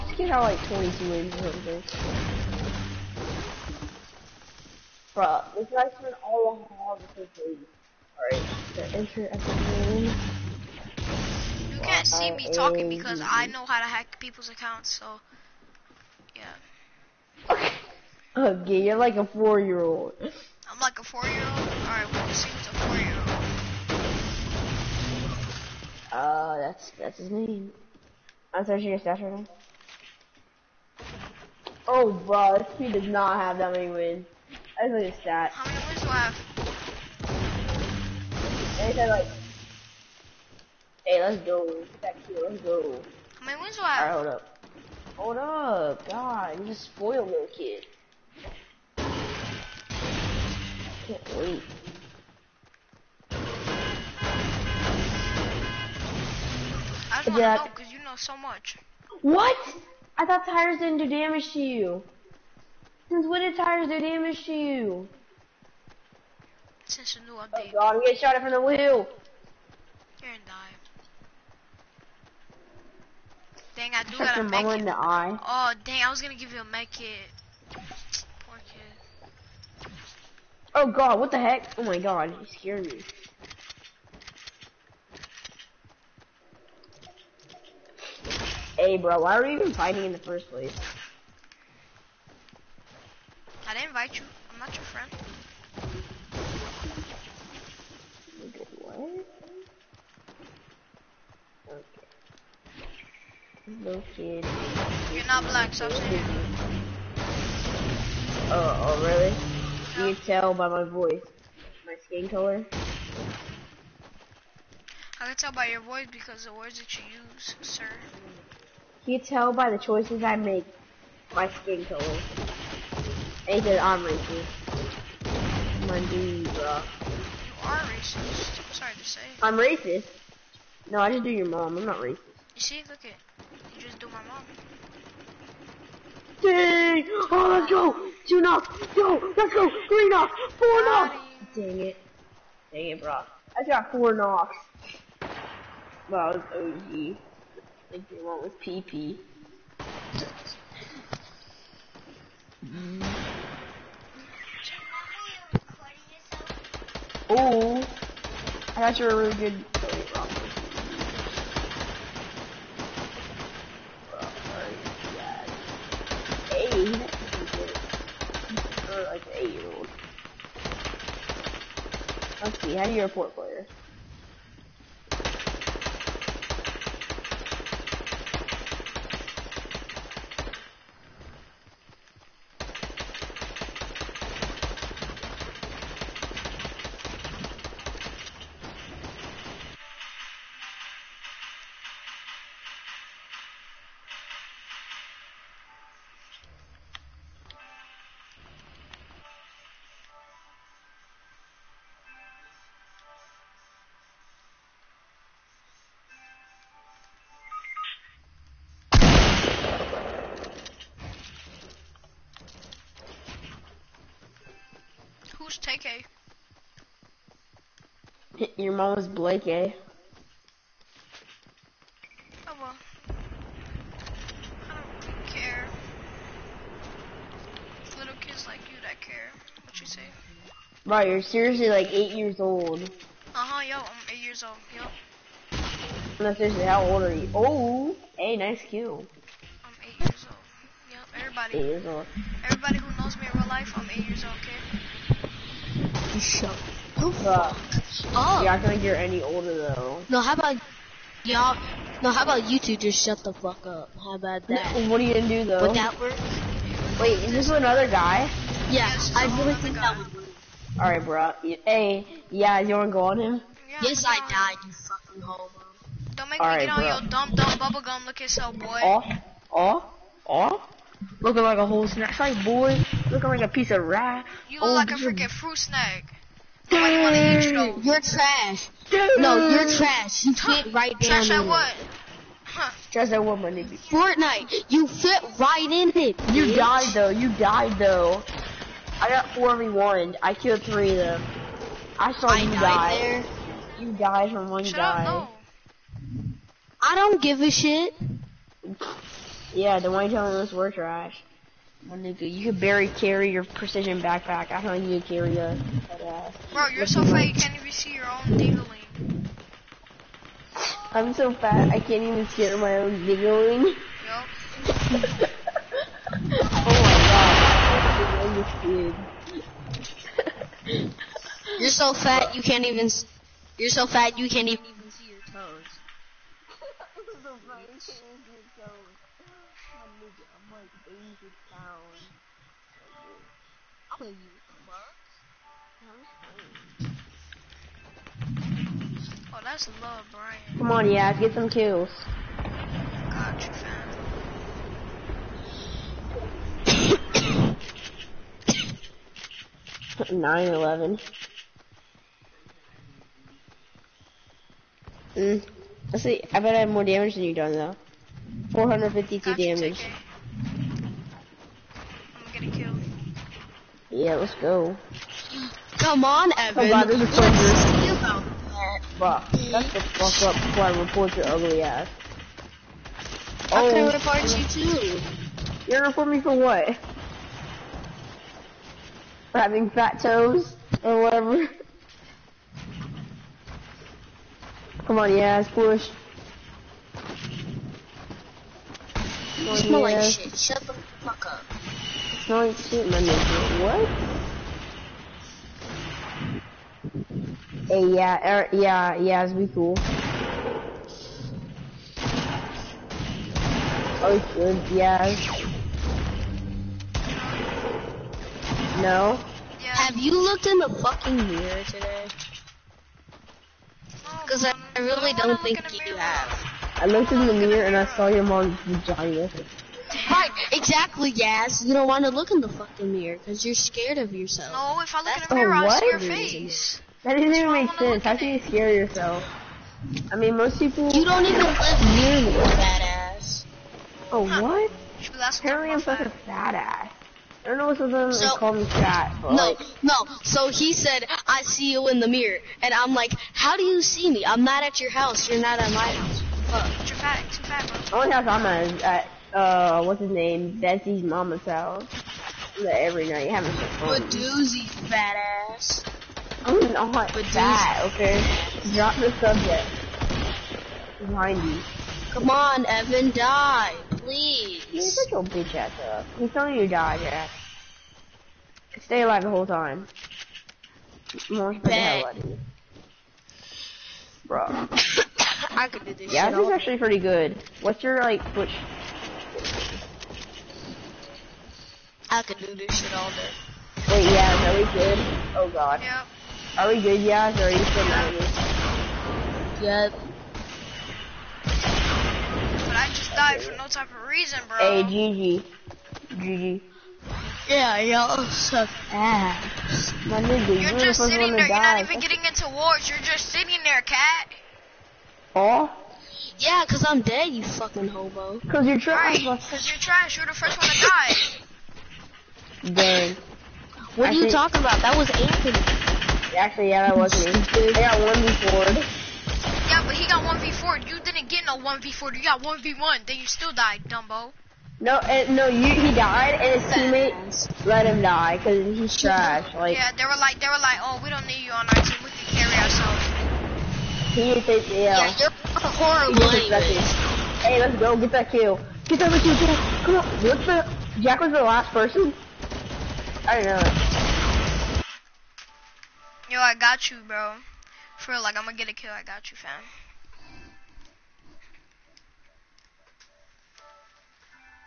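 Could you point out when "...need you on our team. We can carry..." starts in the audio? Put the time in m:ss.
8:51.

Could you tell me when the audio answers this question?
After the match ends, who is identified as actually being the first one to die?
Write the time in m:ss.
8:34.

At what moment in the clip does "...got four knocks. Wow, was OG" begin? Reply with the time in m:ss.
2:23.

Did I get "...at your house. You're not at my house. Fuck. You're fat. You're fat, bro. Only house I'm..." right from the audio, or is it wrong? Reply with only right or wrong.
right.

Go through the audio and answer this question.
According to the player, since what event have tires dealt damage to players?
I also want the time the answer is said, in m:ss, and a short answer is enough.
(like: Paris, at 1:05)
The new update, at 1:06.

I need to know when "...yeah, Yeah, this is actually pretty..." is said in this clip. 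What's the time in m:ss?
7:56.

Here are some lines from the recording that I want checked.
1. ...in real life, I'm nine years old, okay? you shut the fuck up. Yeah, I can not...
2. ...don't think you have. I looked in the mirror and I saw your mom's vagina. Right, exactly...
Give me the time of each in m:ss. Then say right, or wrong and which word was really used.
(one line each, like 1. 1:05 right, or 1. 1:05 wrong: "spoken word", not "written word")
1. 4:03 wrong: "eight", not "nine"
2. 6:55 right.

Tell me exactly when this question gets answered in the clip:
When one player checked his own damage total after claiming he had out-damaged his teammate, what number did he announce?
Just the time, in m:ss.
5:58.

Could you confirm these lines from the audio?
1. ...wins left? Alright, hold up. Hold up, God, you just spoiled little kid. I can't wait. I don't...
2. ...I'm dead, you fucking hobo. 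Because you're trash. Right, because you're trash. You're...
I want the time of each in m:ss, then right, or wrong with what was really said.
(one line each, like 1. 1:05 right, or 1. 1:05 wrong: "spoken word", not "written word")
1. 0:43 right
2. 8:26 right.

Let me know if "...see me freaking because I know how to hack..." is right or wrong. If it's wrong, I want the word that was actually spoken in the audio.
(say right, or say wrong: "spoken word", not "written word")
wrong: "talking", not "freaking".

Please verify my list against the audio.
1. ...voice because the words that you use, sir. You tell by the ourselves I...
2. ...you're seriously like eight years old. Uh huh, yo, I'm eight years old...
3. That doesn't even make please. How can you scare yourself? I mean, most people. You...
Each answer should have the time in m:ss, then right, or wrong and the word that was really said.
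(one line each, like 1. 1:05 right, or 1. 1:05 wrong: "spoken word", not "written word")
1. 1:55 wrong: "choices", not "ourselves"
2. 3:51 right
3. 7:07 wrong: "sense", not "please".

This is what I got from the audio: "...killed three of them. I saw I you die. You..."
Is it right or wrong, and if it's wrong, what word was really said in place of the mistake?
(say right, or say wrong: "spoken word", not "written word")
right.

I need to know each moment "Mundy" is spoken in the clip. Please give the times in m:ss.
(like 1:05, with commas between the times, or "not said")
2:05.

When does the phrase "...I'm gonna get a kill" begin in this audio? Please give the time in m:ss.
9:08.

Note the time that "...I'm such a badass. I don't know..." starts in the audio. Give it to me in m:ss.
7:15.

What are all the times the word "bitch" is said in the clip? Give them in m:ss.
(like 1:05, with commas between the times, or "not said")
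4:46, 7:45.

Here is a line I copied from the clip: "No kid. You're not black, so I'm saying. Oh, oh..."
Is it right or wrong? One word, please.
right.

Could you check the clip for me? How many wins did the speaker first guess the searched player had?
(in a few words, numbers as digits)
22.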